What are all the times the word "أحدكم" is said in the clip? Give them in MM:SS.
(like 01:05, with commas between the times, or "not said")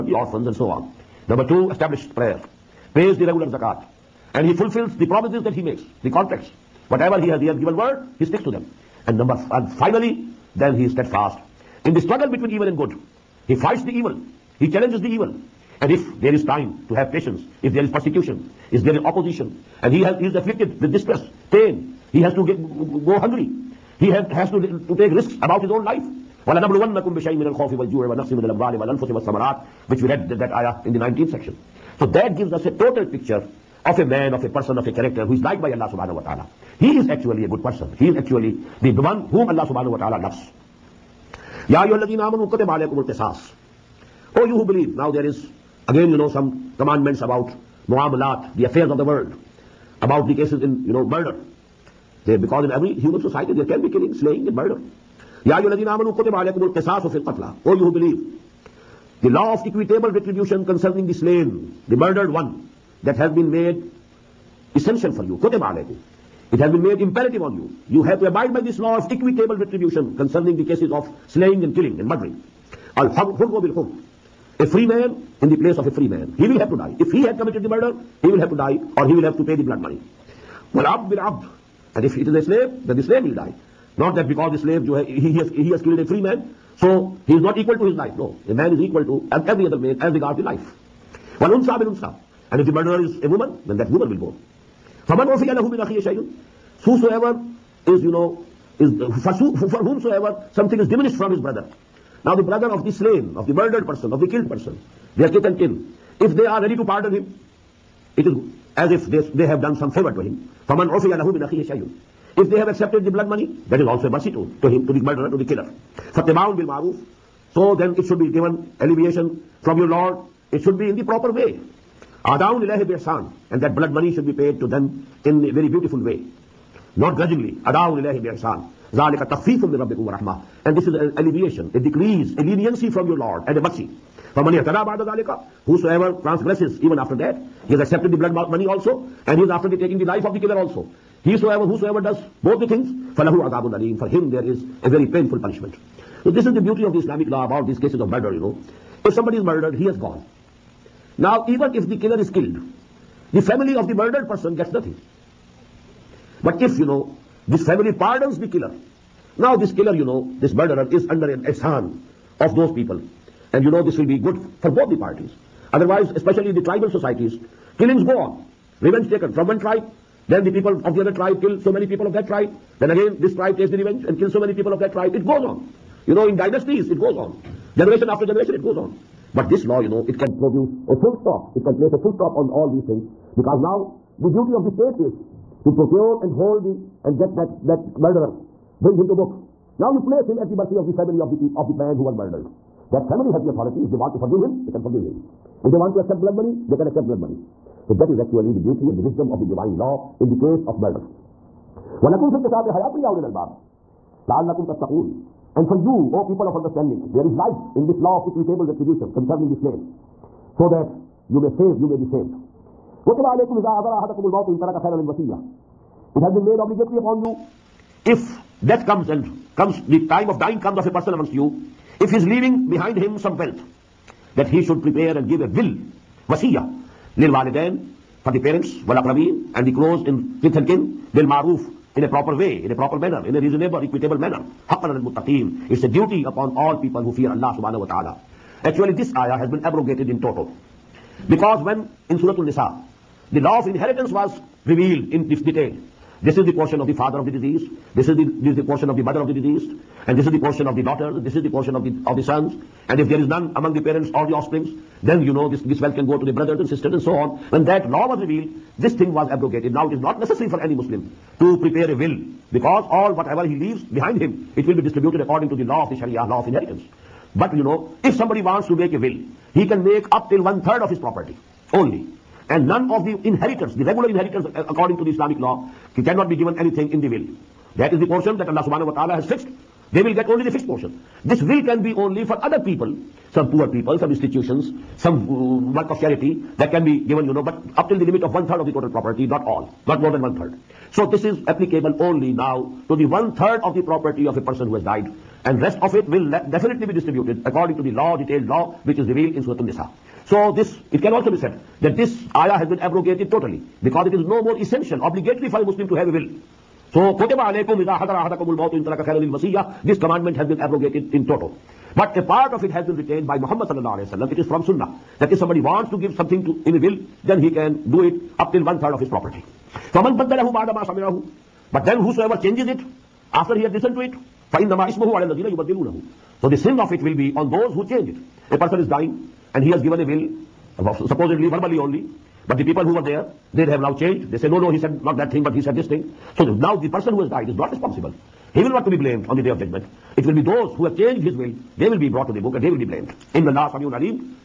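03:33, 05:08.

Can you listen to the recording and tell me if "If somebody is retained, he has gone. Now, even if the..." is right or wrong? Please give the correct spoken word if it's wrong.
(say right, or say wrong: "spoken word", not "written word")
wrong: "murdered", not "retained".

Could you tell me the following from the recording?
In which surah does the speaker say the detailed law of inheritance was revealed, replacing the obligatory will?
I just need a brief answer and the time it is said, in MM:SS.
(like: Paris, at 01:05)
Surah Al-Nisa, at 04:02.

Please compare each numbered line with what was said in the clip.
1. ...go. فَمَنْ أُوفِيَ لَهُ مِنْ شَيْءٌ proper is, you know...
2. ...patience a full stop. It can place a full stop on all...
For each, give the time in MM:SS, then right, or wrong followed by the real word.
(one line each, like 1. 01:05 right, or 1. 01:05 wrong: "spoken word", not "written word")
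1. 01:34 wrong: "whosoever", not "proper"
2. 03:00 wrong: "produce", not "patience".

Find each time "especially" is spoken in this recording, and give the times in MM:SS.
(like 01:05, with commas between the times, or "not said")
02:46.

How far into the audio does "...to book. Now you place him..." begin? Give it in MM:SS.
03:09.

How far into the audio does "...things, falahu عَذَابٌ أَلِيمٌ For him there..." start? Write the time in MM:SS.
02:22.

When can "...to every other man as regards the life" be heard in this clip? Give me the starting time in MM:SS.
01:29.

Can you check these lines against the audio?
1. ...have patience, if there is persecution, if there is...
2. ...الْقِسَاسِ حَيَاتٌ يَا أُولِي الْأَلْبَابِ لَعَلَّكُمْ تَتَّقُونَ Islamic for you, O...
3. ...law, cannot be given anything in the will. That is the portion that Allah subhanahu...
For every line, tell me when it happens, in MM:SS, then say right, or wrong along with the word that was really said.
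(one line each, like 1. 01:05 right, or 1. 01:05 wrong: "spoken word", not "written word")
1. 00:16 right
2. 03:22 wrong: "And", not "Islamic"
3. 04:35 right.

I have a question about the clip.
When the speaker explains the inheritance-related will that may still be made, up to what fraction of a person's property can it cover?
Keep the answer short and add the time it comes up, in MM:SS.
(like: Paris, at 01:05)
1/3, at 04:30.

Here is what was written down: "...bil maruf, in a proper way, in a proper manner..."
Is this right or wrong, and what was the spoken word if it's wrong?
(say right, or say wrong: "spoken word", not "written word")
right.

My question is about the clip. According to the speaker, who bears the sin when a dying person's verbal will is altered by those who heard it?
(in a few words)
those who change it.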